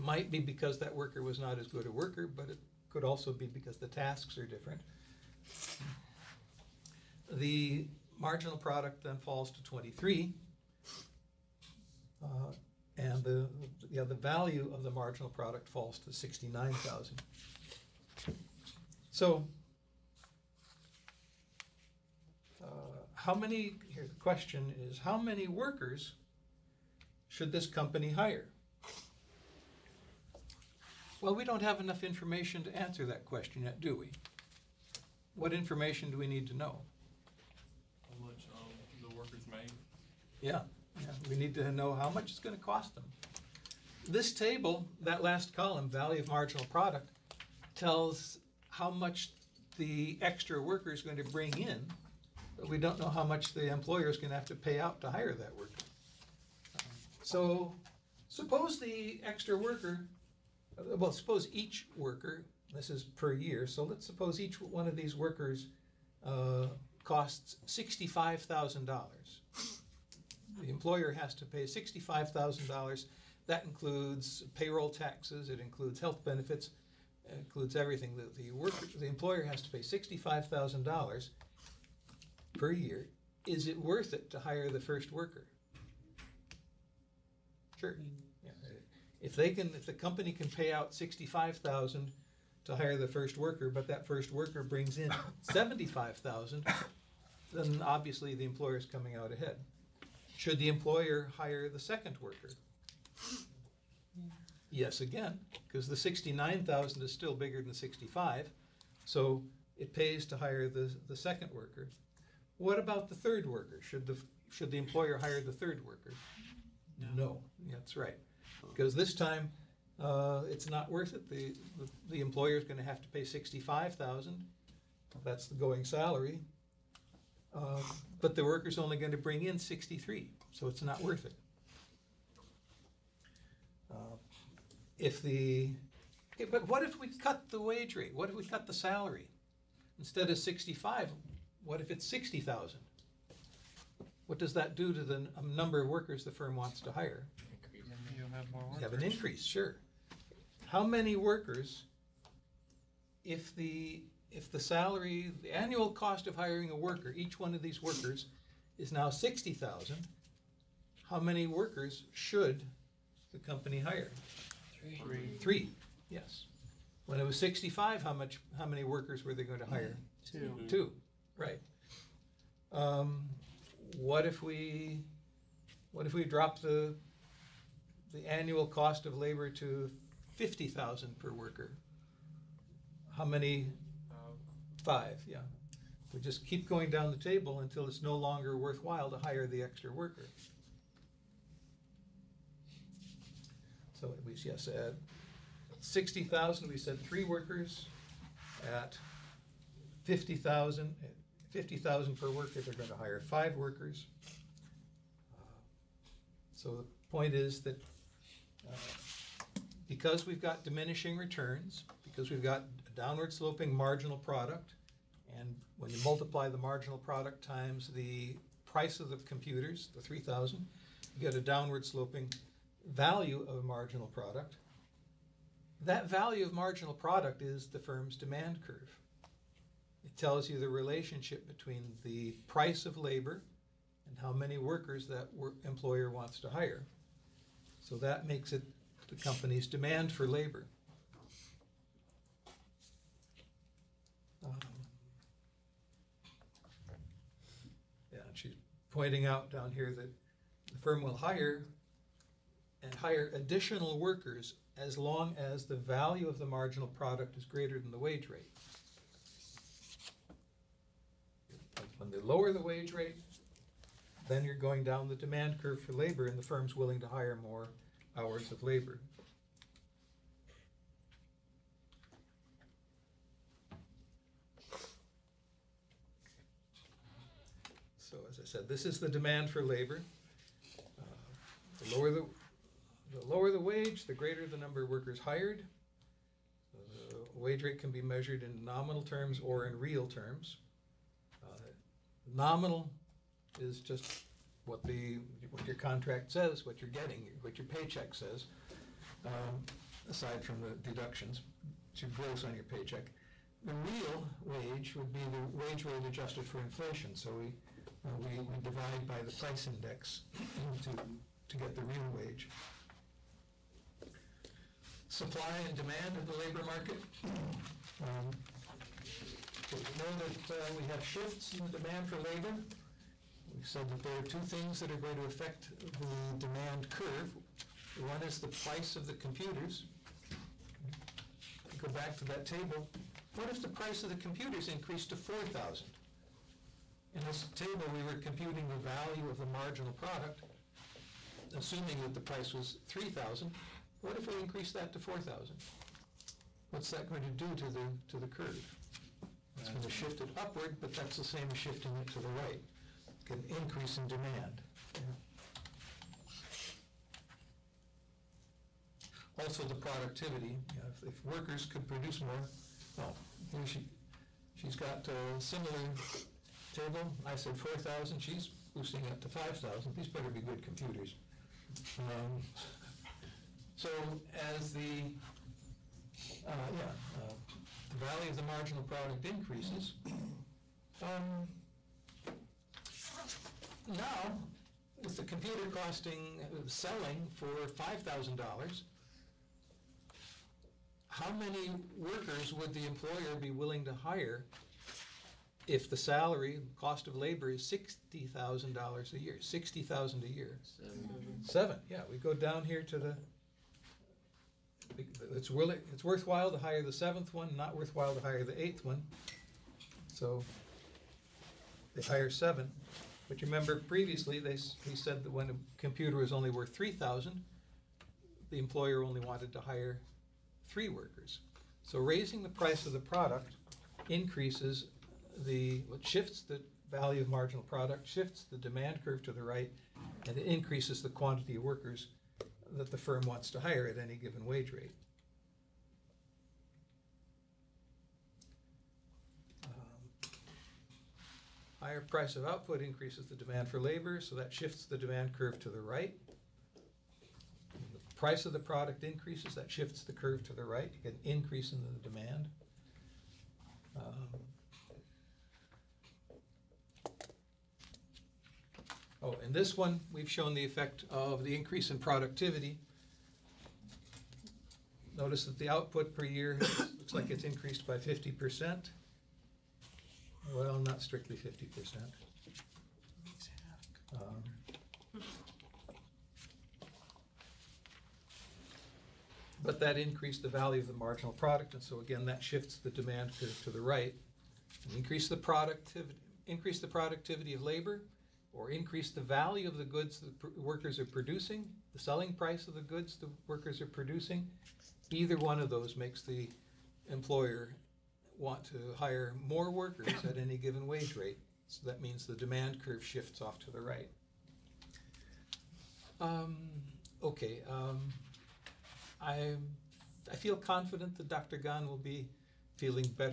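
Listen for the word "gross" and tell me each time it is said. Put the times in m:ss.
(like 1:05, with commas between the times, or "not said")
5:02.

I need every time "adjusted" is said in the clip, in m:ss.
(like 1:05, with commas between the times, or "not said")
5:06.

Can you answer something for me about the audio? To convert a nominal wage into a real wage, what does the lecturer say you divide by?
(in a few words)
The price index.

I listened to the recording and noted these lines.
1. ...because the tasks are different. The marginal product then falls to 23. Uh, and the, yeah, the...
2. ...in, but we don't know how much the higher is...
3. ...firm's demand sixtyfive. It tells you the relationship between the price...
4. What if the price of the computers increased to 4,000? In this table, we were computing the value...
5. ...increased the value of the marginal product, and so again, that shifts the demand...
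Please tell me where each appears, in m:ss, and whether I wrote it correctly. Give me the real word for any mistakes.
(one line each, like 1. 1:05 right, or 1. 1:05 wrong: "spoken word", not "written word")
1. 0:03 right
2. 0:51 wrong: "employer", not "higher"
3. 3:47 wrong: "curve", not "sixtyfive"
4. 5:33 right
5. 7:59 right.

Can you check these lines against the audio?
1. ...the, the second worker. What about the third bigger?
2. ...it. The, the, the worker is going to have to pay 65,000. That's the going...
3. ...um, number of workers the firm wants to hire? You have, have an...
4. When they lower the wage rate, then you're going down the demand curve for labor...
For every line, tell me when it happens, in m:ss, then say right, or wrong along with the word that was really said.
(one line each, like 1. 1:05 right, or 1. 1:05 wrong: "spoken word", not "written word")
1. 1:50 wrong: "worker", not "bigger"
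2. 2:01 wrong: "employer", not "worker"
3. 2:25 right
4. 4:21 right.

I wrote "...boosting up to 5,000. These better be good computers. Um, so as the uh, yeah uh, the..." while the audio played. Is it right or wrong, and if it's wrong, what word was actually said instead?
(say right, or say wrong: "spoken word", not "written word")
right.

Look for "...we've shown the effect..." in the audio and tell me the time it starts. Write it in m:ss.
7:40.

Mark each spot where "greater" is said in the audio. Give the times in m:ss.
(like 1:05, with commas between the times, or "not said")
4:17, 4:44.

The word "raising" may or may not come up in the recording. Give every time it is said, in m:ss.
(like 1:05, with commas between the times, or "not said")
7:02.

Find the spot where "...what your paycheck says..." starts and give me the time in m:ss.
4:57.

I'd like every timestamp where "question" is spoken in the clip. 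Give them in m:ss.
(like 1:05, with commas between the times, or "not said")
0:24, 0:33.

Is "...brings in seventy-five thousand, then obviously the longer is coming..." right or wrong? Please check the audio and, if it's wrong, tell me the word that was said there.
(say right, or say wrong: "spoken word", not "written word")
wrong: "employer", not "longer".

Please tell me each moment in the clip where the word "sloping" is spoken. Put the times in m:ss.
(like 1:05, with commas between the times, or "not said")
3:33, 3:41.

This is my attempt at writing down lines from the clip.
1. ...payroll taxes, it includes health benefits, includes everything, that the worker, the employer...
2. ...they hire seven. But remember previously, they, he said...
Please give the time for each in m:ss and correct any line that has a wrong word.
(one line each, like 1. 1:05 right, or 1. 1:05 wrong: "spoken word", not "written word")
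1. 1:14 right
2. 6:51 right.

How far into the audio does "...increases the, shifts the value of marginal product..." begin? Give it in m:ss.
7:04.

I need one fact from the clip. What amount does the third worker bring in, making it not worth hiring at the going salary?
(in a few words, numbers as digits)
$63,000.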